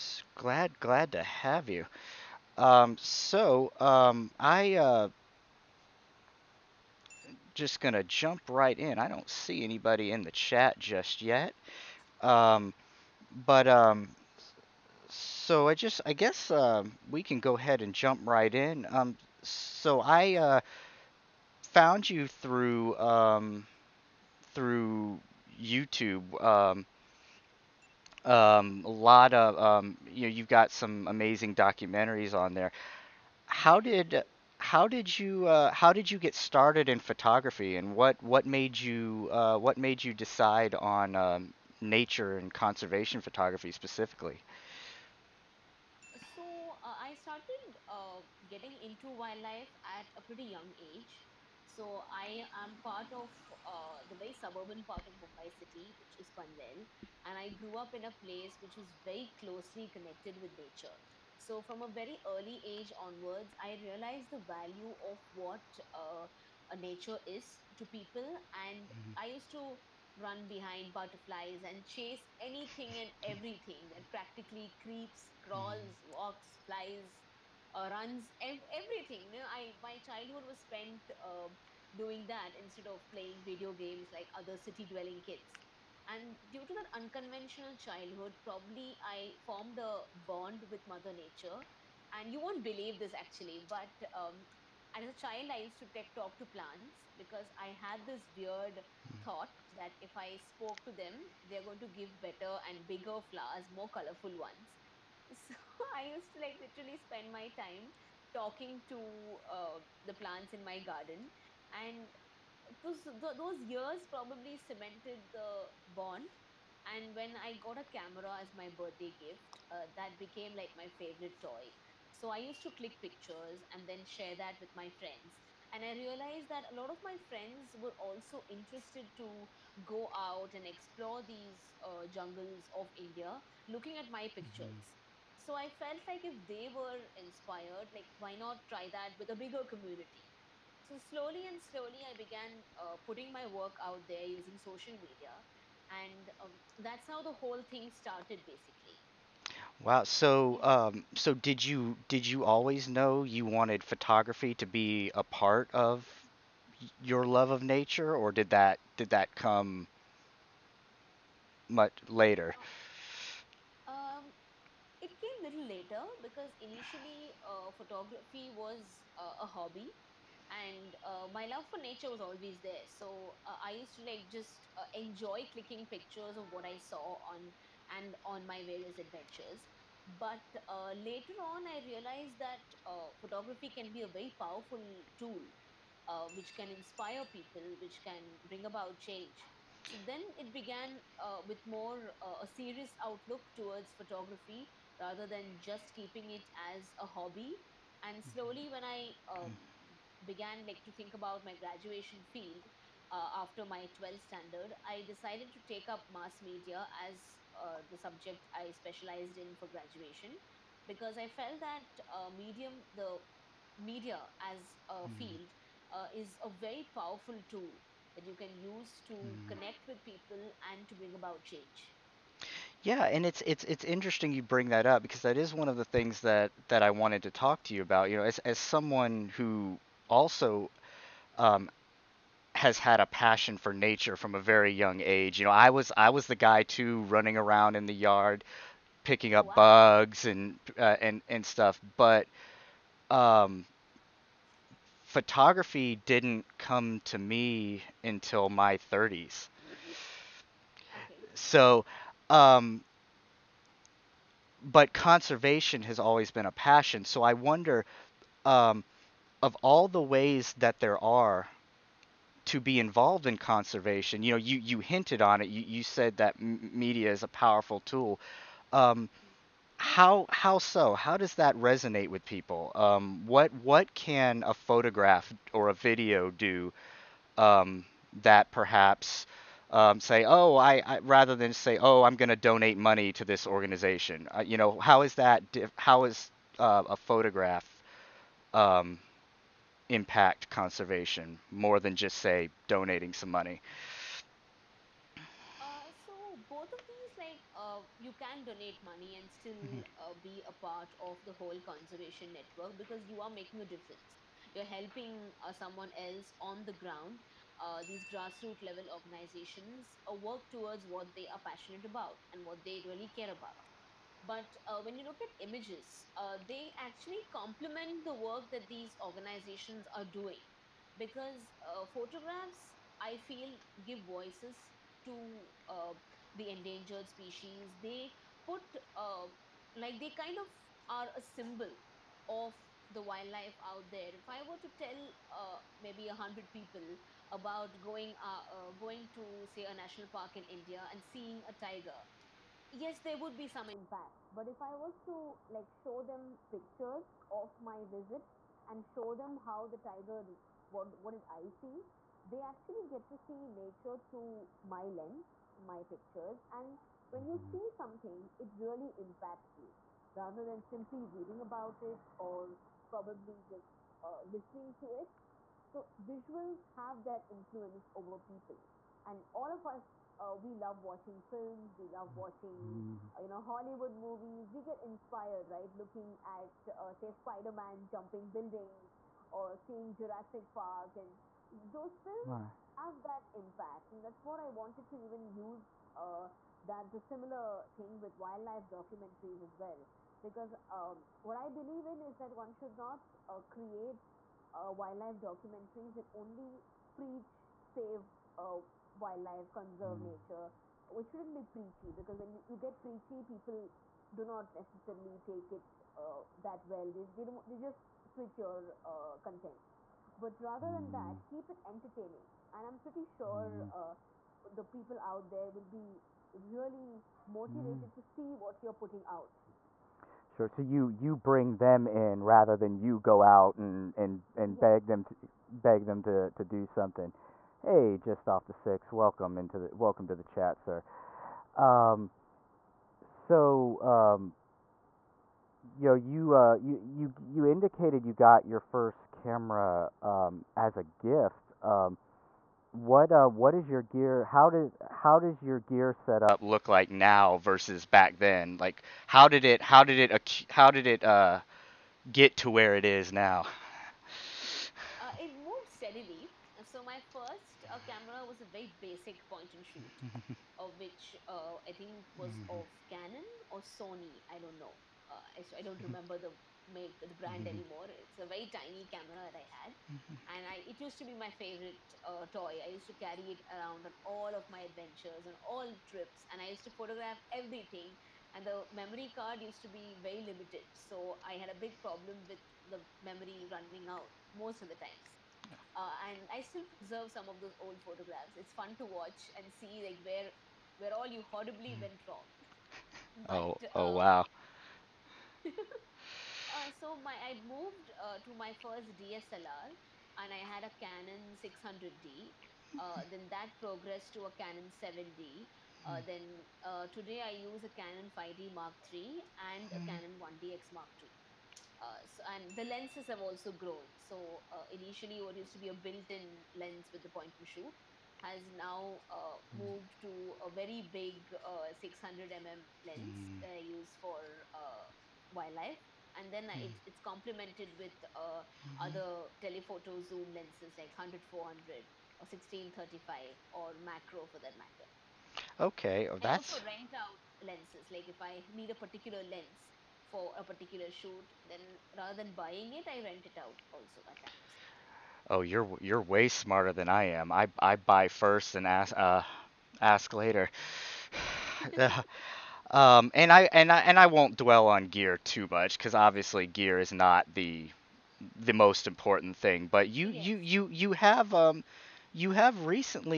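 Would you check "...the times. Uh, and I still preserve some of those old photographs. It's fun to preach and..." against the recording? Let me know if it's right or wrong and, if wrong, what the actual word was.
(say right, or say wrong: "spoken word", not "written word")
wrong: "watch", not "preach".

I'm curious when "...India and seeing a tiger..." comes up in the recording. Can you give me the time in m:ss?
5:40.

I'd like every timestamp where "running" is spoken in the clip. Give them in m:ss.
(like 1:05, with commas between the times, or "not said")
3:57, 8:03.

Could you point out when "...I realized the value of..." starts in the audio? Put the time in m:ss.
1:03.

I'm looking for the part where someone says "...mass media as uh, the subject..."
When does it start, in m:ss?
3:26.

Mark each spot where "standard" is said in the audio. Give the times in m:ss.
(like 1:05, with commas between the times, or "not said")
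3:24.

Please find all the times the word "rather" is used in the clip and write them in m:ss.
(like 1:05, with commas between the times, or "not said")
3:15, 4:41, 6:00, 6:50, 7:02, 9:01.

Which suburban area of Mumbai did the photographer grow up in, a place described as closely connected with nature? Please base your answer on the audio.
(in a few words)
Panvel.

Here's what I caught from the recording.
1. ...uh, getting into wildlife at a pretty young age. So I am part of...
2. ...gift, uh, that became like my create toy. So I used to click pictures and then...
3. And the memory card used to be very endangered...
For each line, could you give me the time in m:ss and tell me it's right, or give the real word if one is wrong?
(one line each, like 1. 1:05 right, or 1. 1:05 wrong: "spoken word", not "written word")
1. 0:47 right
2. 1:59 wrong: "favorite", not "create"
3. 7:58 wrong: "limited", not "endangered".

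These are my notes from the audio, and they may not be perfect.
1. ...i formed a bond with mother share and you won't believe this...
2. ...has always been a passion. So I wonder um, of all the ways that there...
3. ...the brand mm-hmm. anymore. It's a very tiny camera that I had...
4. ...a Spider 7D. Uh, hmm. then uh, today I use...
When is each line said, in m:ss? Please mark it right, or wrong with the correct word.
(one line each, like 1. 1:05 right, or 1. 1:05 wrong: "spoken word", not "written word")
1. 1:29 wrong: "nature", not "share"
2. 4:15 right
3. 7:46 right
4. 8:24 wrong: "Canon", not "Spider".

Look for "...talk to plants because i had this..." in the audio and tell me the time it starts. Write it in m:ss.
1:36.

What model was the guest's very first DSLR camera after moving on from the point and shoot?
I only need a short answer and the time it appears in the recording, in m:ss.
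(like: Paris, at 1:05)
Canon 600D, at 8:20.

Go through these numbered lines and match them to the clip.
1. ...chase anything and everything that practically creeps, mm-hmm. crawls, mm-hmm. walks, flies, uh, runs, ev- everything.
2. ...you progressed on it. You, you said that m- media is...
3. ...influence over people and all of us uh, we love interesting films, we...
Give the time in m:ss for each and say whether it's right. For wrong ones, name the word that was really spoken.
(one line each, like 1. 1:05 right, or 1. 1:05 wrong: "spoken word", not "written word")
1. 1:11 right
2. 4:24 wrong: "hinted", not "progressed"
3. 6:07 wrong: "watching", not "interesting".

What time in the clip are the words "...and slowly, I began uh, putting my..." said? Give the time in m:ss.
2:21.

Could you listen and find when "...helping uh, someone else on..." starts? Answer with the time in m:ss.
5:04.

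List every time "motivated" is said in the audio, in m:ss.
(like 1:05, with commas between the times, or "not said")
6:57.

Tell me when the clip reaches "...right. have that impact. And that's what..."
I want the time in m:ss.
6:22.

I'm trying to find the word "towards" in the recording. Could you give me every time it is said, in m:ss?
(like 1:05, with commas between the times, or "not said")
3:13, 5:10.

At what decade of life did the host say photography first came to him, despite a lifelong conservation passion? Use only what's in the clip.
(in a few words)
30s.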